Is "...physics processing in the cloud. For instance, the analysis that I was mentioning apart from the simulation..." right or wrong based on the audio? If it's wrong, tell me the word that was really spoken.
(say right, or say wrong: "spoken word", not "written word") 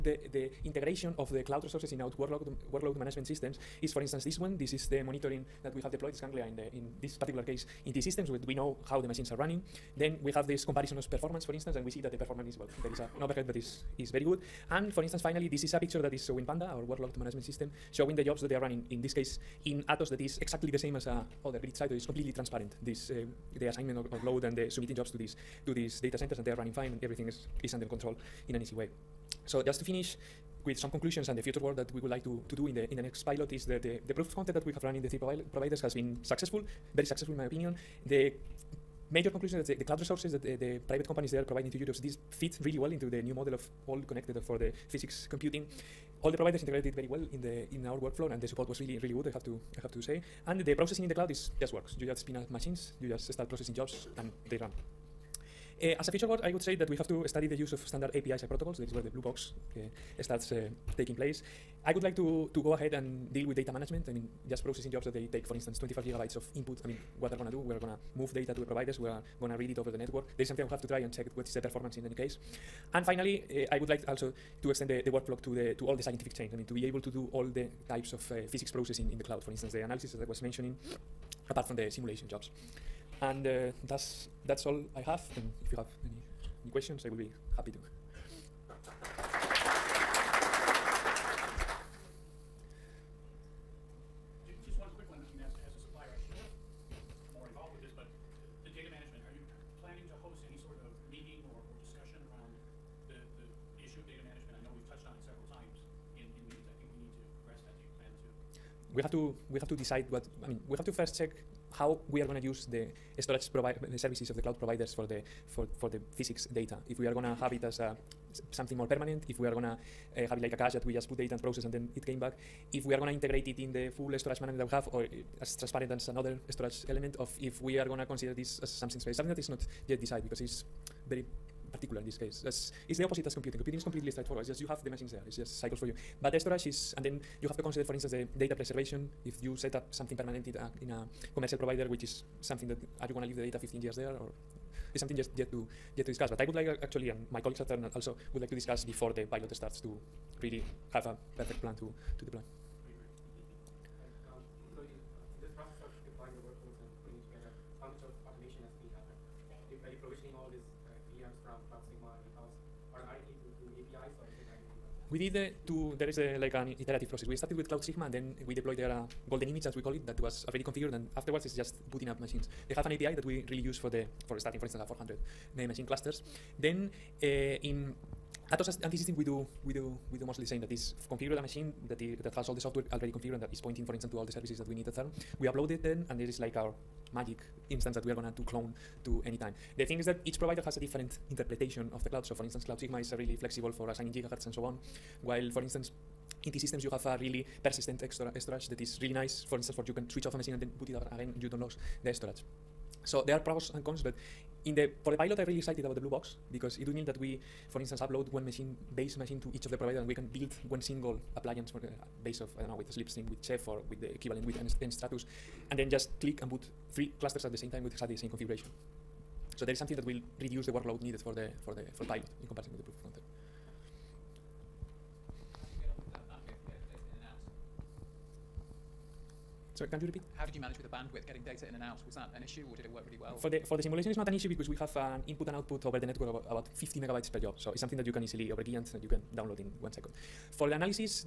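right.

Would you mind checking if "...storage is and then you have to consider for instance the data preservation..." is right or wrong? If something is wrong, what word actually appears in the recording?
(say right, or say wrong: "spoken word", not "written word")
right.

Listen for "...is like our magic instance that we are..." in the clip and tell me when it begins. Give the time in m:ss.
3:06.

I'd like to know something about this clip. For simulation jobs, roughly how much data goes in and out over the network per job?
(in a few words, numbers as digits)
50 megabytes.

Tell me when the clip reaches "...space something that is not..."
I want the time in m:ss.
2:08.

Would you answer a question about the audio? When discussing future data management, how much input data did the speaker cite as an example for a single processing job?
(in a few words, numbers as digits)
25 gigabytes.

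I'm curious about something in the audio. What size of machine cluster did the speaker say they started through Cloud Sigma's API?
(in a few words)
400 machines.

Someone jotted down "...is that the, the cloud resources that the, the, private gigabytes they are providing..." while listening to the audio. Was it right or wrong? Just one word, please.
wrong.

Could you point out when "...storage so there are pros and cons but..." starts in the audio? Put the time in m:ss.
3:22.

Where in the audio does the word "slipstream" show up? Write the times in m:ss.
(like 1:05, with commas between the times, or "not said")
3:32.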